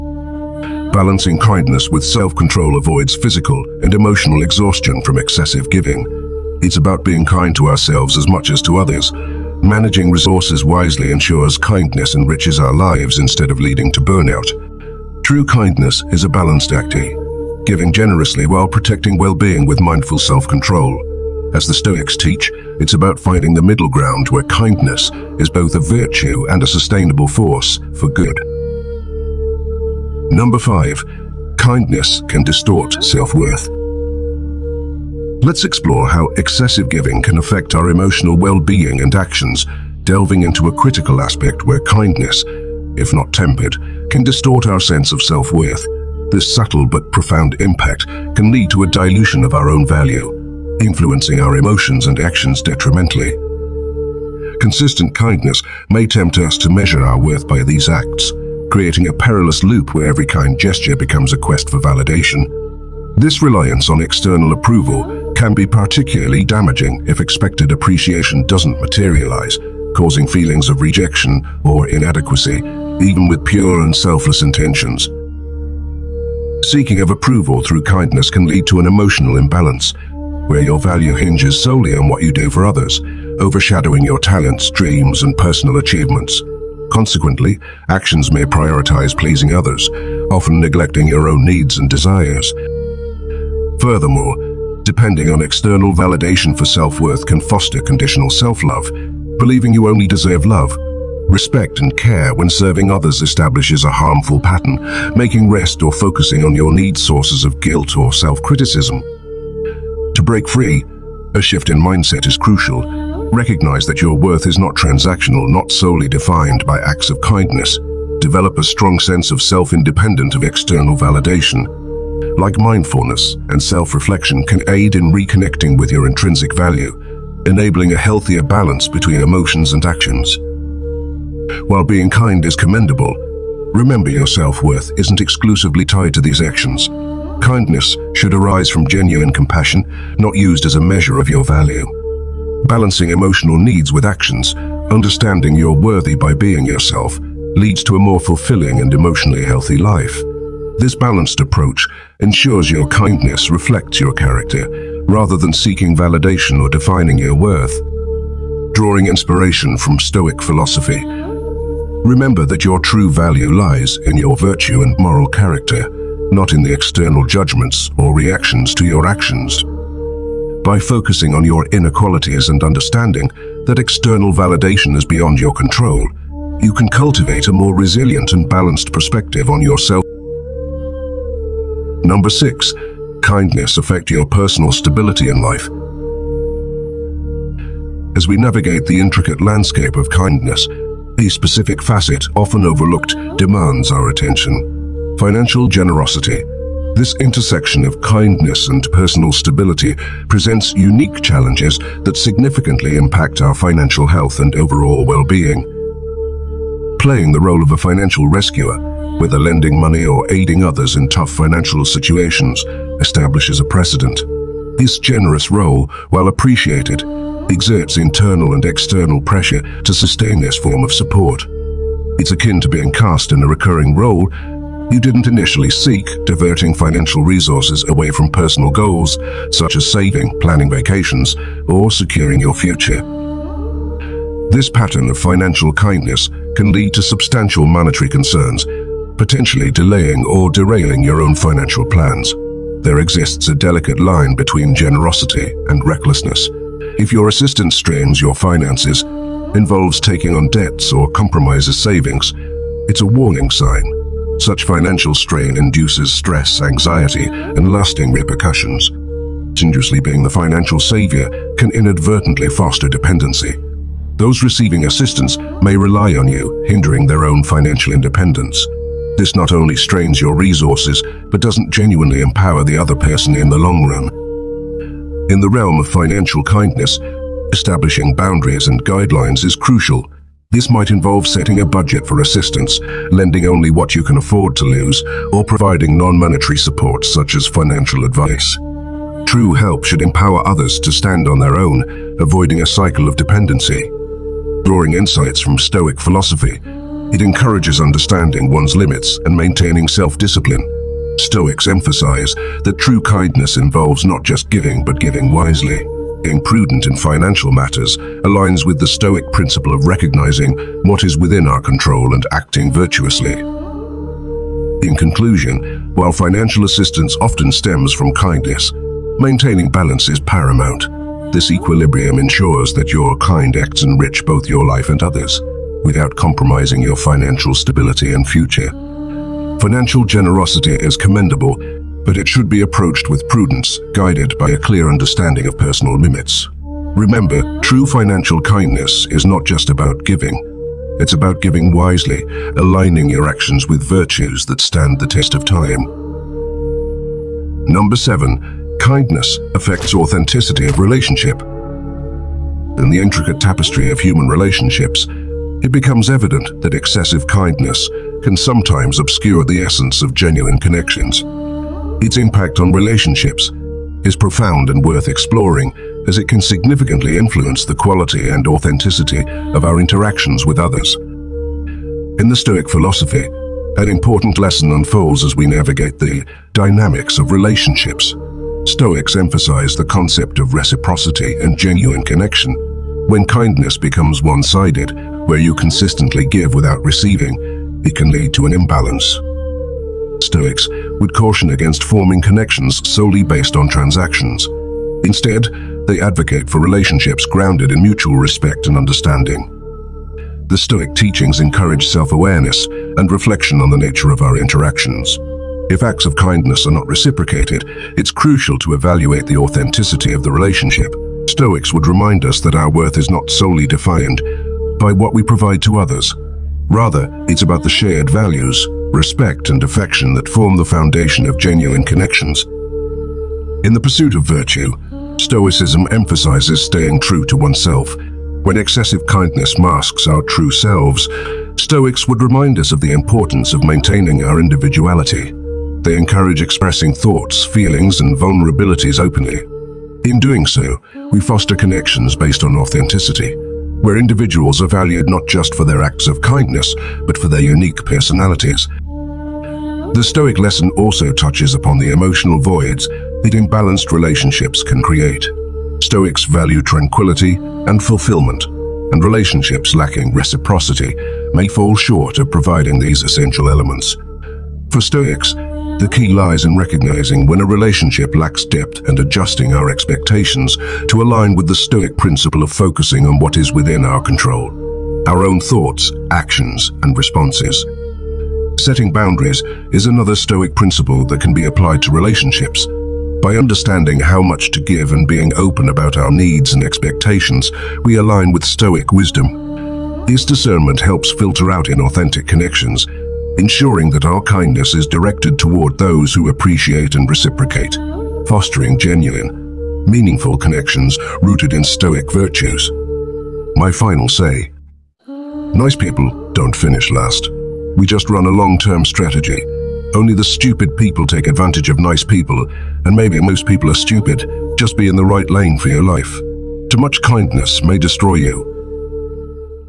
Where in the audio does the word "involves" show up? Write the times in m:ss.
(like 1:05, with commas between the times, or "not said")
4:09, 4:40, 5:03.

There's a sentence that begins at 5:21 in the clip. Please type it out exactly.
This equilibrium ensures that your kind acts enrich both your life and others, without compromising your financial stability and future.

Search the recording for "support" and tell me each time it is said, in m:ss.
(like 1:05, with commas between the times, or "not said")
3:40, 4:46.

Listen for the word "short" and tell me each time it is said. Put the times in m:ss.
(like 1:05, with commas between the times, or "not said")
7:41.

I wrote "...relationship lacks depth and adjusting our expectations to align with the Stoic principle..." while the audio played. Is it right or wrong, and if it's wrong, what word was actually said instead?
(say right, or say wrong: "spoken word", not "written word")
right.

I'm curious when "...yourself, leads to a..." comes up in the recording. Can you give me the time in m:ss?
2:26.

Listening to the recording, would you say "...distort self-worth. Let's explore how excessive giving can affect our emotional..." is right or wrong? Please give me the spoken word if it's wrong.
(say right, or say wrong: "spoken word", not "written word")
right.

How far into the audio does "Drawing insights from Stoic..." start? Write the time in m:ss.
4:54.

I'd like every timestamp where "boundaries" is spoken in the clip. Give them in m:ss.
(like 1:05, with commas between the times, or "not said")
4:38, 7:58.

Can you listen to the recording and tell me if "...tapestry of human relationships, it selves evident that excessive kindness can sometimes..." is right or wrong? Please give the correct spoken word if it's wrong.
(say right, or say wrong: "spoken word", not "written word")
wrong: "becomes", not "selves".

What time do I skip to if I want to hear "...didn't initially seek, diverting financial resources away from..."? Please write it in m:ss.
3:44.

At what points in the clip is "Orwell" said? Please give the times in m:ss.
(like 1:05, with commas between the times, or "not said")
not said.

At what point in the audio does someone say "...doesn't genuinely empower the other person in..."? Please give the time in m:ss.
4:31.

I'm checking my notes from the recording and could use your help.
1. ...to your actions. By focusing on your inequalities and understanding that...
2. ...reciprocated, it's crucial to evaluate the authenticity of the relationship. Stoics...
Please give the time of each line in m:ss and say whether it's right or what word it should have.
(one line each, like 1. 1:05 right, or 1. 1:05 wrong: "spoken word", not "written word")
1. 2:48 right
2. 6:46 right.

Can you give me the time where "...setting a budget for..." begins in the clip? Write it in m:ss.
4:41.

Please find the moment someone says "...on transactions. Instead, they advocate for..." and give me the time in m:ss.
6:33.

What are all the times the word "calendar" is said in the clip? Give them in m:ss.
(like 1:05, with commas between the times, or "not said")
not said.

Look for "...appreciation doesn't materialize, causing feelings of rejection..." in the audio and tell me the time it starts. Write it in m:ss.
1:07.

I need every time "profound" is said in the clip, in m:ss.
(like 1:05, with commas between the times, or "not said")
0:47, 6:04.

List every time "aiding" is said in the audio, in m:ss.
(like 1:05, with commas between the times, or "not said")
3:30.